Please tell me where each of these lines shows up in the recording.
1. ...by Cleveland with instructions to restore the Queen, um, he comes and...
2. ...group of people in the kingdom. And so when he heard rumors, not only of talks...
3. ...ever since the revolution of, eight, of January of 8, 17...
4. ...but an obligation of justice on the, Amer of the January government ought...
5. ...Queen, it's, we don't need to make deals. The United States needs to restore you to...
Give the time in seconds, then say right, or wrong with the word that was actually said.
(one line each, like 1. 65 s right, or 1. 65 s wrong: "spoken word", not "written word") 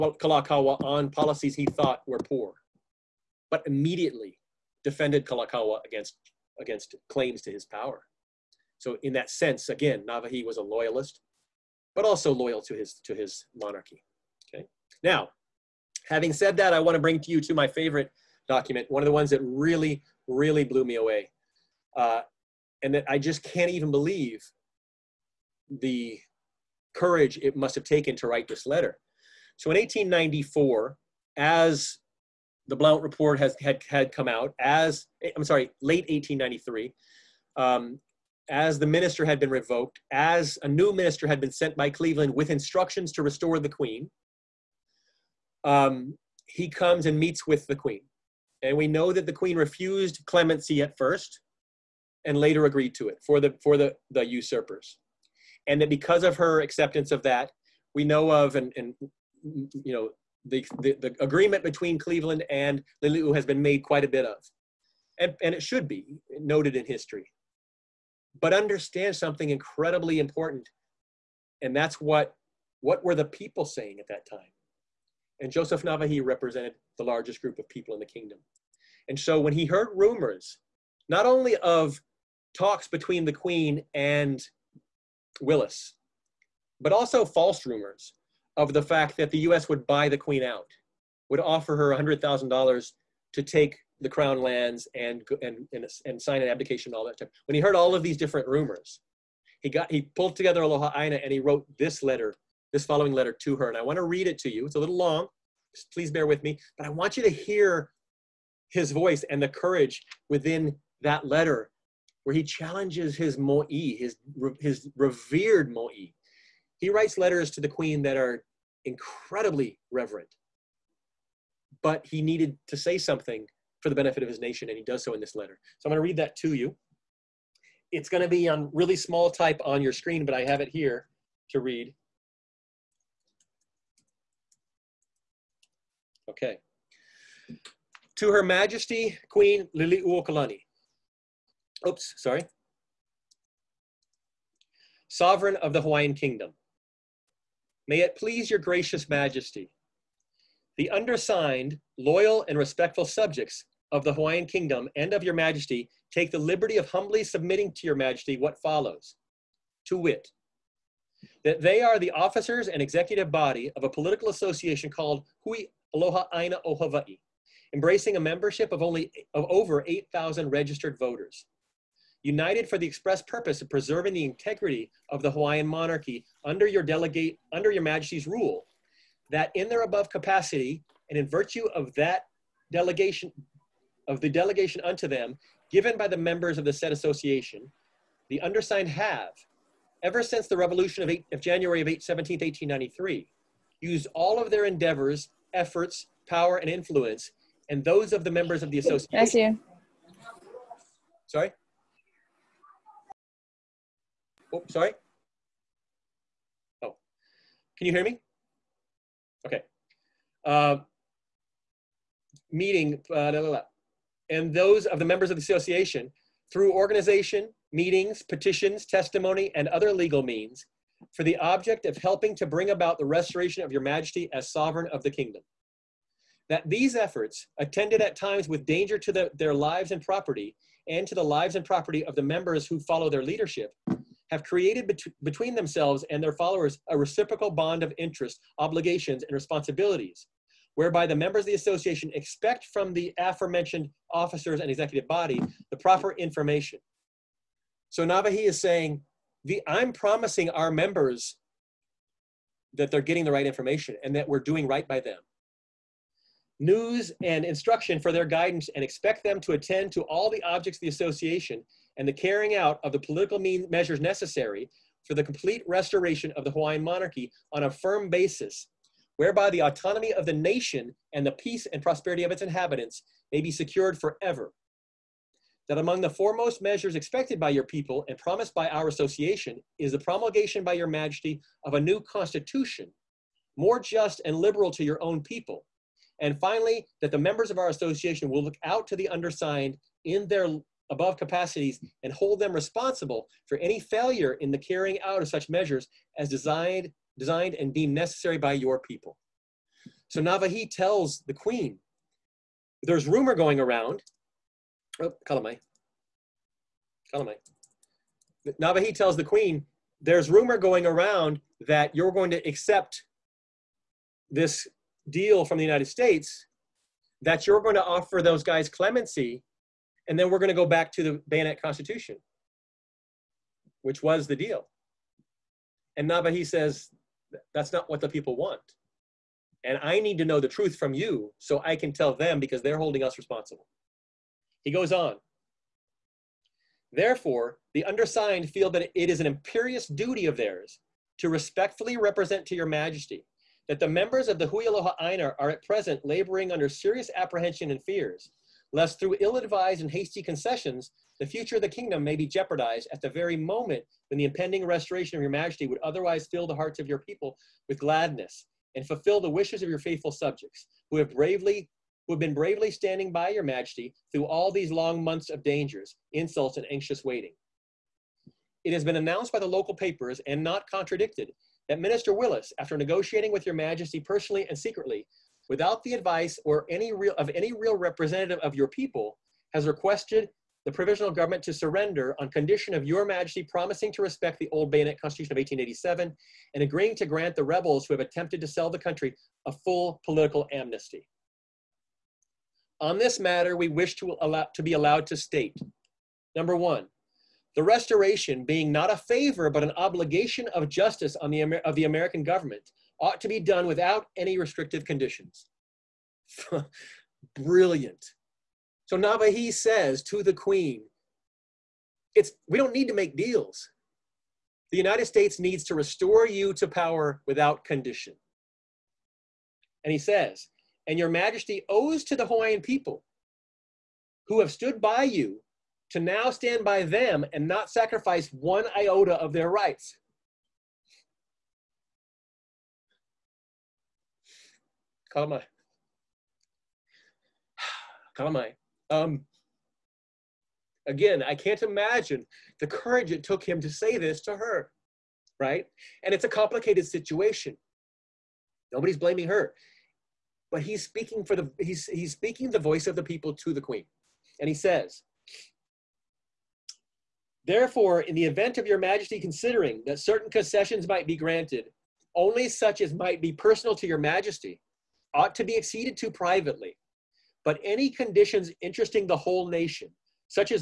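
1. 41 s right
2. 77 s right
3. 190 s right
4. 399 s wrong: "American", not "January"
5. 410 s right.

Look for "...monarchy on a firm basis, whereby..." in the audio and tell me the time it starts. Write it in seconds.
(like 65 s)
266 s.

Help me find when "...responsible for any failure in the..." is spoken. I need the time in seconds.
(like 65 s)
292 s.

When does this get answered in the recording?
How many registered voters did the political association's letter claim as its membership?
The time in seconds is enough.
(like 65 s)
169 s.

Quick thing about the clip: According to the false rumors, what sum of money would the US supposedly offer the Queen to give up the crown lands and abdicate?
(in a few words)
$100,000.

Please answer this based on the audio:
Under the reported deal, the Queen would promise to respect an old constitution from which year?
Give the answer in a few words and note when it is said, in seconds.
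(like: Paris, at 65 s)
1887, at 385 s.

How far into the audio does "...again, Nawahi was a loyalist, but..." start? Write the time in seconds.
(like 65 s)
9 s.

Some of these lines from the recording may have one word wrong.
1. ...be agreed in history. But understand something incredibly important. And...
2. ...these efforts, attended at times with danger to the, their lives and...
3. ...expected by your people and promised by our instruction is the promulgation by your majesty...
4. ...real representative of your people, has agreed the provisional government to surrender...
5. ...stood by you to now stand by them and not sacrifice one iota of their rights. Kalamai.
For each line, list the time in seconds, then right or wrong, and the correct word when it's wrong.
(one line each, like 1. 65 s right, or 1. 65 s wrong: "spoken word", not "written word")
1. 65 s wrong: "noted", not "agreed"
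2. 226 s right
3. 276 s wrong: "association", not "instruction"
4. 377 s wrong: "requested", not "agreed"
5. 424 s right.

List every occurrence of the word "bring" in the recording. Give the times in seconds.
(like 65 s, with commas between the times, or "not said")
17 s, 222 s.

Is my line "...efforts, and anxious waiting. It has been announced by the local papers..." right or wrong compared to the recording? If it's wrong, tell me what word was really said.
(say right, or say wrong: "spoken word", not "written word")
wrong: "insults", not "efforts".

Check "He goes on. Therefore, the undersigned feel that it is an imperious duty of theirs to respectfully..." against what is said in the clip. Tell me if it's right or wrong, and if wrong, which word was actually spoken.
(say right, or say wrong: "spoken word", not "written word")
right.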